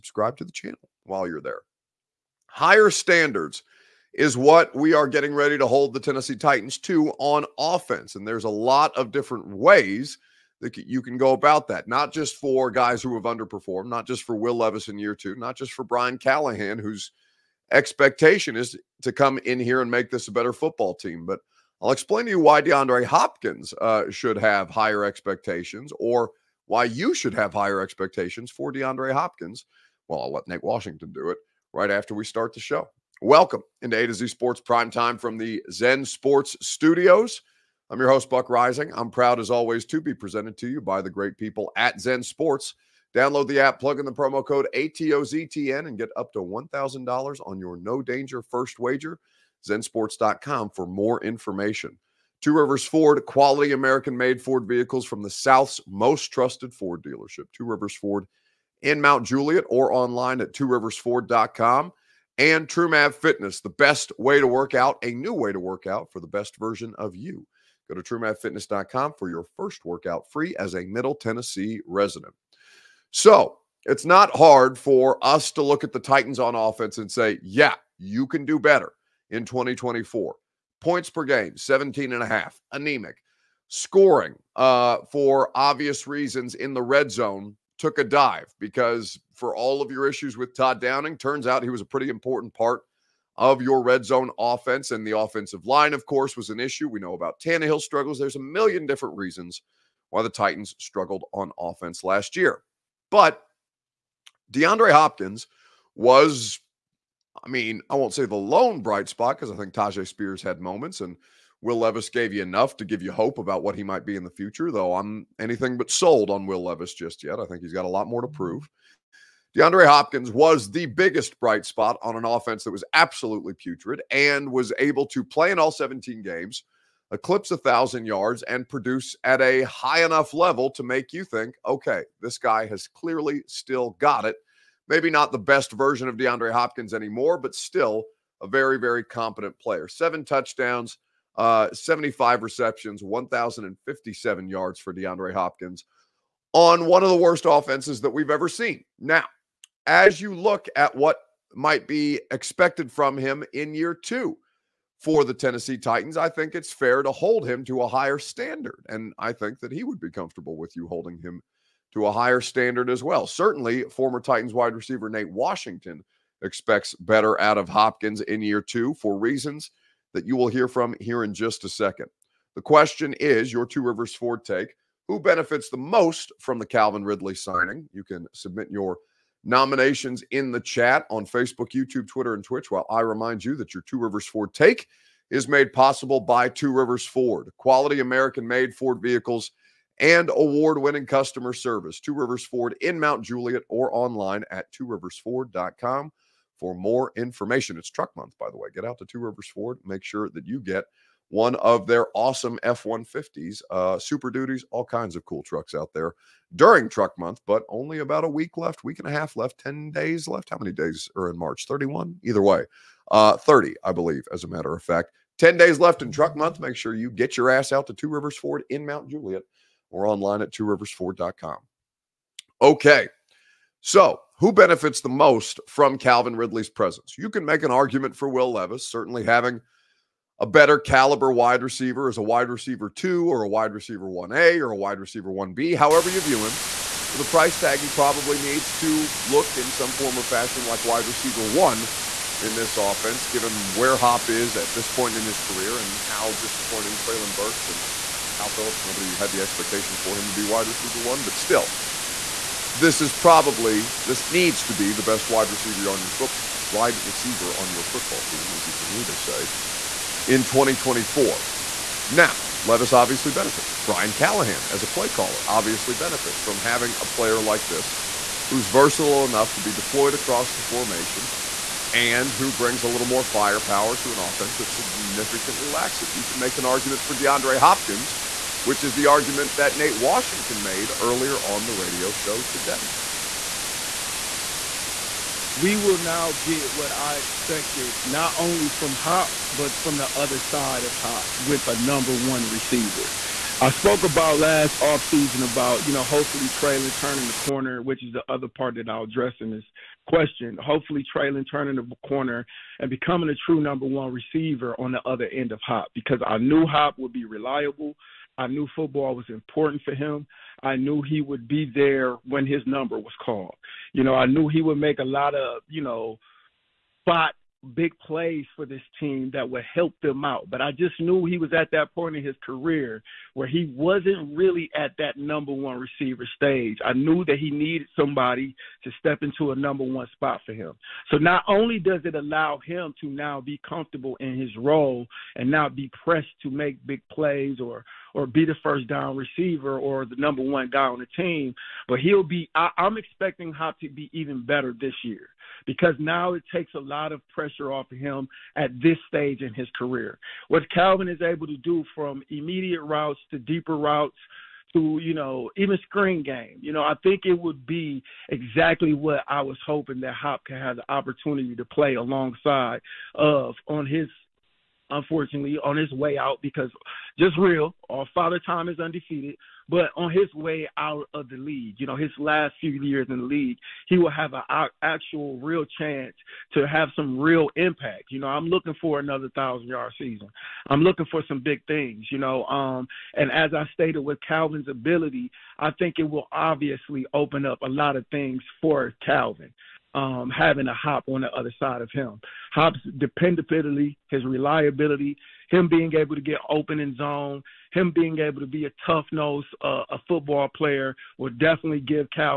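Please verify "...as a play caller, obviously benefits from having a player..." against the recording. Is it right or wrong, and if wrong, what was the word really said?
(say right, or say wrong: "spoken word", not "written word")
right.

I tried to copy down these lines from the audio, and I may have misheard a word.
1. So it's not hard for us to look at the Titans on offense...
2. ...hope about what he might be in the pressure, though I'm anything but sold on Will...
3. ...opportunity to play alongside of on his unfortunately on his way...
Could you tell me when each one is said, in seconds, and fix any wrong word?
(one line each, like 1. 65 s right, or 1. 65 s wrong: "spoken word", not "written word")
1. 73 s right
2. 113 s wrong: "future", not "pressure"
3. 360 s right.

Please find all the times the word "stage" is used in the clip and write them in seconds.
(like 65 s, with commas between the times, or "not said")
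326 s, 349 s.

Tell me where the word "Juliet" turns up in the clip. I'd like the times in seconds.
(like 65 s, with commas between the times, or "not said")
59 s, 193 s, 219 s.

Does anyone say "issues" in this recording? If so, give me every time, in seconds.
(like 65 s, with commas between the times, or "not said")
90 s, 96 s.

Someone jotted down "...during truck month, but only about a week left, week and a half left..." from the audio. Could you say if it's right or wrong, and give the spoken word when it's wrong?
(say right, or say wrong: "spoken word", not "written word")
right.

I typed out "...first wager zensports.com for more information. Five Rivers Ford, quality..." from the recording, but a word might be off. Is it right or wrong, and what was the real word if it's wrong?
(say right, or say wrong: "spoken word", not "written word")
wrong: "Two", not "Five".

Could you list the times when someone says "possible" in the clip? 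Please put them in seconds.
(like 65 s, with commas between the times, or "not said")
185 s.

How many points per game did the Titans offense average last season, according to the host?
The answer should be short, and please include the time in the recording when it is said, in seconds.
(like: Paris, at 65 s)
17.5, at 81 s.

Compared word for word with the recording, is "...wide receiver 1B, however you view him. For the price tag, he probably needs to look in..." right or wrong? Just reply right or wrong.
right.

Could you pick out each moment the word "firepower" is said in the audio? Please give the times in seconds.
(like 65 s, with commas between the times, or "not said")
273 s.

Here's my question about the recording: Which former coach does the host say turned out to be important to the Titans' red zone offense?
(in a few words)
Todd Downing.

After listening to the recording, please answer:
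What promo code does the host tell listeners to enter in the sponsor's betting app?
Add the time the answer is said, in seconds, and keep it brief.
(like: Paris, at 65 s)
ATOZTN, at 44 s.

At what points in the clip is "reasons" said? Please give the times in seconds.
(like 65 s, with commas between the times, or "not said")
86 s, 99 s, 169 s.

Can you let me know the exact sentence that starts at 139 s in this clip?
Seven touchdowns, uh, 75 receptions, 1,057 yards for DeAndre Hopkins on one of the worst offenses that we've ever seen.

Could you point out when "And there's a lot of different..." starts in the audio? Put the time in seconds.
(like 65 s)
8 s.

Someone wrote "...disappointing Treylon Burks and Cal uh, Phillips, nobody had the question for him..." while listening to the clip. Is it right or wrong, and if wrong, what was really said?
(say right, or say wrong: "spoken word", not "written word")
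wrong: "expectation", not "question".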